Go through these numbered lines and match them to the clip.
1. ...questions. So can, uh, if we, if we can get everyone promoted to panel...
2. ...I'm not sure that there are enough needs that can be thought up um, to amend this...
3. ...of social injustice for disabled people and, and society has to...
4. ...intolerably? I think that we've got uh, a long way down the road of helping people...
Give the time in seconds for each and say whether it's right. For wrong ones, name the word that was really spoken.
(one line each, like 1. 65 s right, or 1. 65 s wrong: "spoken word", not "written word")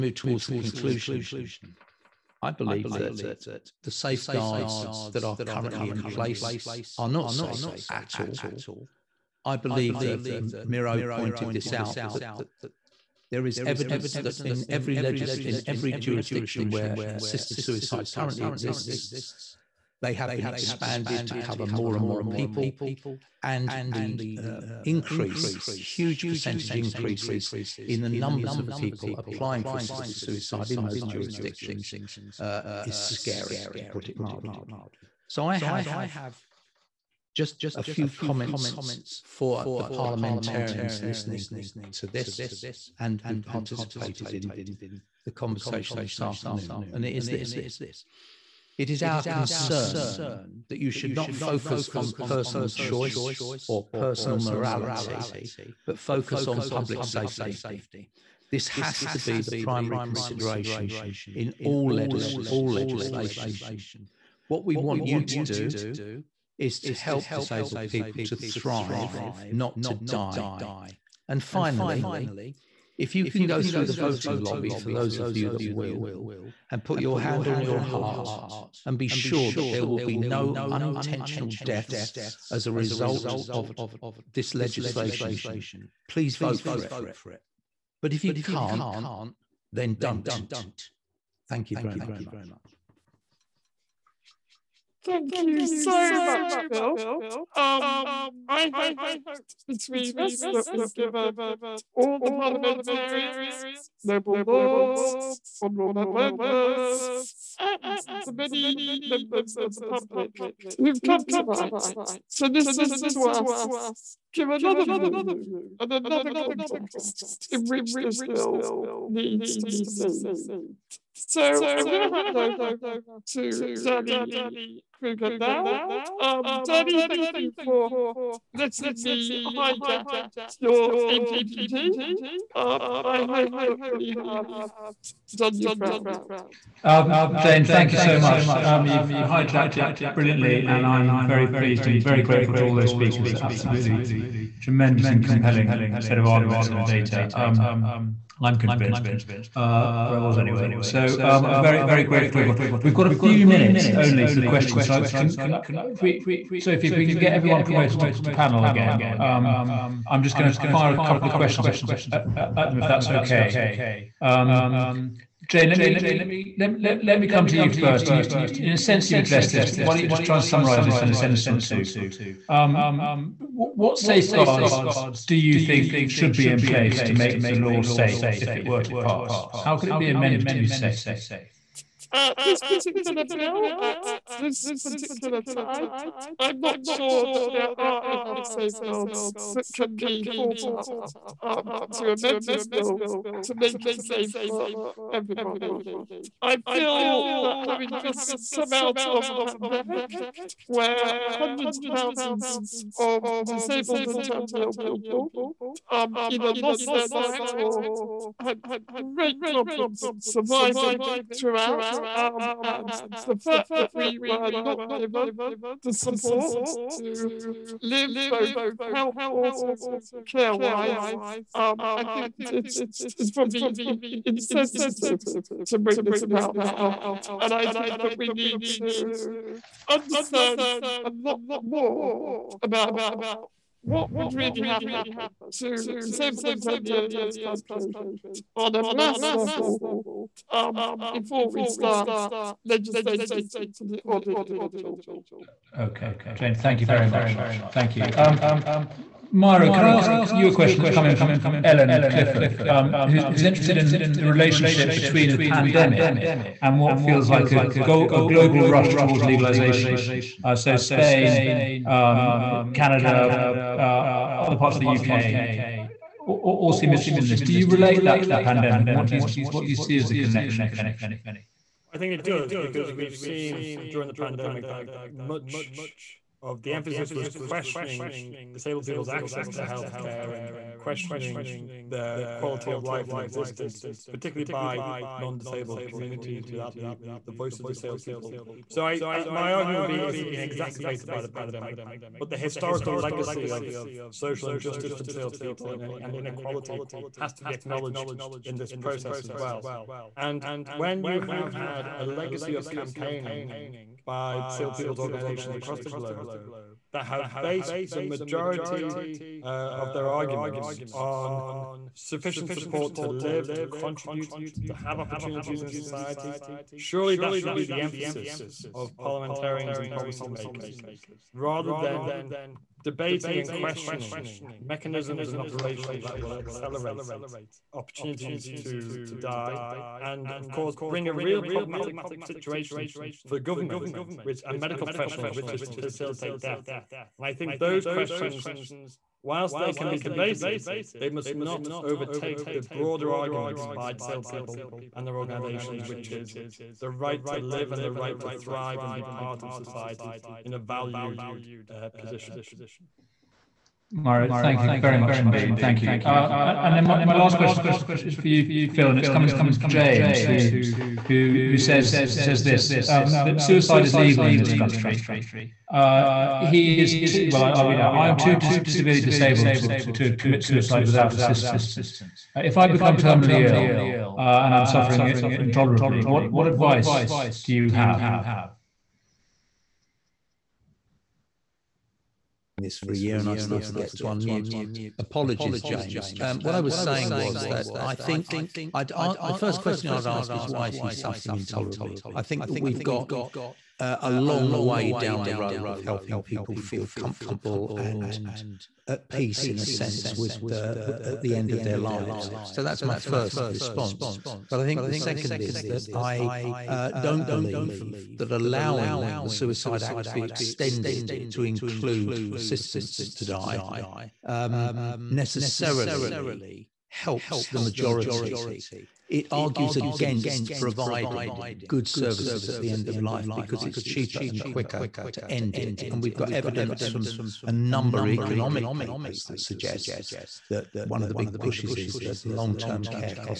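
1. 154 s right
2. 186 s wrong: "safeguards", not "needs"
3. 293 s wrong: "inequality", not "society"
4. 391 s right.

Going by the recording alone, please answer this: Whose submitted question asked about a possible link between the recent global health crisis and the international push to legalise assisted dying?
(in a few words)
Ellen Clifford.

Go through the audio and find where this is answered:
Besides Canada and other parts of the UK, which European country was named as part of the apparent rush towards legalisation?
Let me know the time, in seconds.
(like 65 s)
260 s.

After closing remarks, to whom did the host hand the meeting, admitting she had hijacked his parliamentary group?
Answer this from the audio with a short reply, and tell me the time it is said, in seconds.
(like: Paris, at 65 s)
Danny Kruger, at 123 s.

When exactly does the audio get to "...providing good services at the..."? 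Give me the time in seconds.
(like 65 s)
420 s.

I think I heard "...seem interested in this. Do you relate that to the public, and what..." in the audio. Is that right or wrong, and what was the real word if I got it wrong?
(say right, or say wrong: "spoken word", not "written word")
wrong: "pandemic", not "public".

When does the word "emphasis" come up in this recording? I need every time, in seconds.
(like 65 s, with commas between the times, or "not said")
276 s, 317 s.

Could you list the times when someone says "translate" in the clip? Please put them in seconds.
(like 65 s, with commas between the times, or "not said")
not said.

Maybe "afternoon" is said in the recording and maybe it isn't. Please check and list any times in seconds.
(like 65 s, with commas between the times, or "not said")
46 s.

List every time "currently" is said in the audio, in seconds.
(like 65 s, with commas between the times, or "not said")
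5 s, 18 s.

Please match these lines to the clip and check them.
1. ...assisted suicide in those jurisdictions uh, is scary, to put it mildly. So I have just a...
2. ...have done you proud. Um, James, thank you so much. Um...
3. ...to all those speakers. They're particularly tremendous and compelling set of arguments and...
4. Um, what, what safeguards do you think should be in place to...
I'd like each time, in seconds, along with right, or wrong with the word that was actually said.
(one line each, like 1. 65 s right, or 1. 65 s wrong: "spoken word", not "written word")
1. 29 s right
2. 134 s wrong: "Jane", not "James"
3. 142 s wrong: "absolutely", not "particularly"
4. 172 s right.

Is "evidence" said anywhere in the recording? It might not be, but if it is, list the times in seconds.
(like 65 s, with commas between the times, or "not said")
13 s, 426 s.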